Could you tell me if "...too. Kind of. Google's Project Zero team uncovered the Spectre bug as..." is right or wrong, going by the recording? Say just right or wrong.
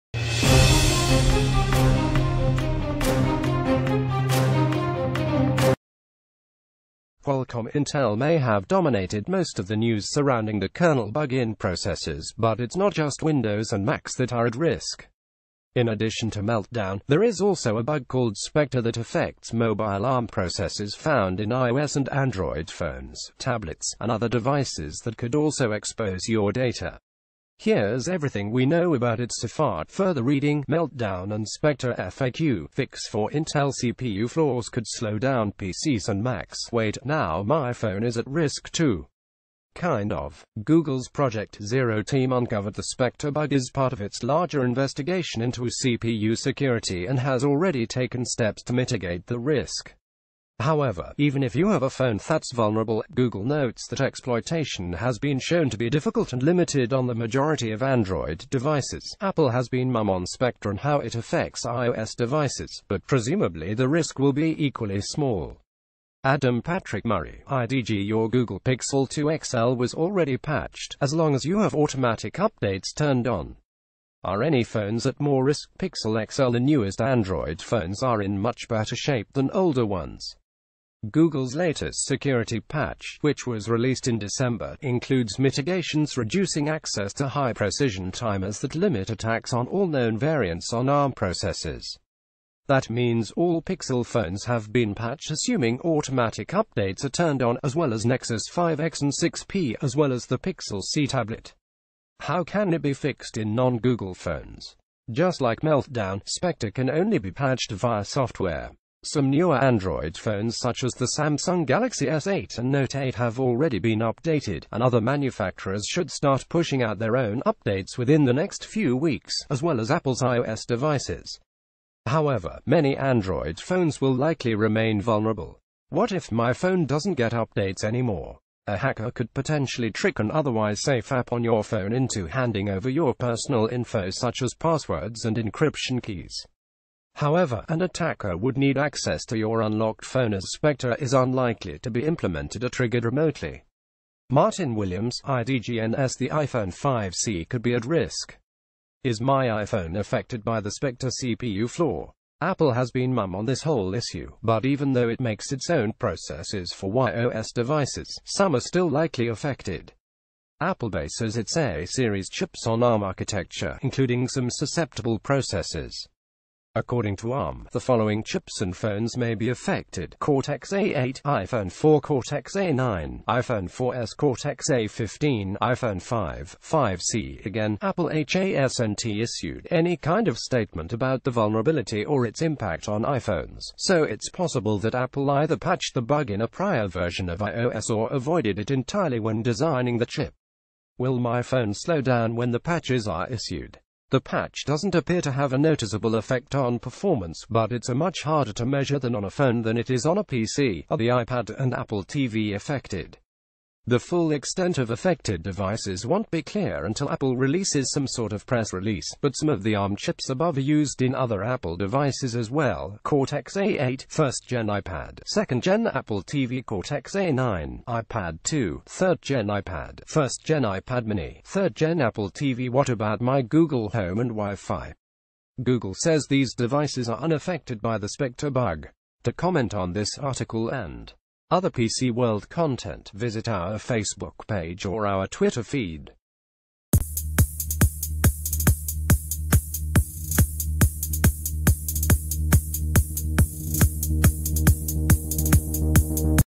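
right.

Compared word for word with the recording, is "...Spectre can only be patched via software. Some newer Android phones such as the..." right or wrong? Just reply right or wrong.
right.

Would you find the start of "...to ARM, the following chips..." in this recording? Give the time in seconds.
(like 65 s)
167 s.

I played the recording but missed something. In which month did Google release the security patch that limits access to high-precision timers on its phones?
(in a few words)
December.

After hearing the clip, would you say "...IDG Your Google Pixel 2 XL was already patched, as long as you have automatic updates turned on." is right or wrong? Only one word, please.
right.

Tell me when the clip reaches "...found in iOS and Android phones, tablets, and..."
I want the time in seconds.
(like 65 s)
20 s.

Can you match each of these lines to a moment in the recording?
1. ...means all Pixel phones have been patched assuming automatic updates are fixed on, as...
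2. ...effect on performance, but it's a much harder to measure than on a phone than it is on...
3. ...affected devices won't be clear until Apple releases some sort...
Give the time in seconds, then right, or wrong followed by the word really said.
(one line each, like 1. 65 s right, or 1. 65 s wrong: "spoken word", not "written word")
1. 92 s wrong: "turned", not "fixed"
2. 196 s right
3. 204 s right.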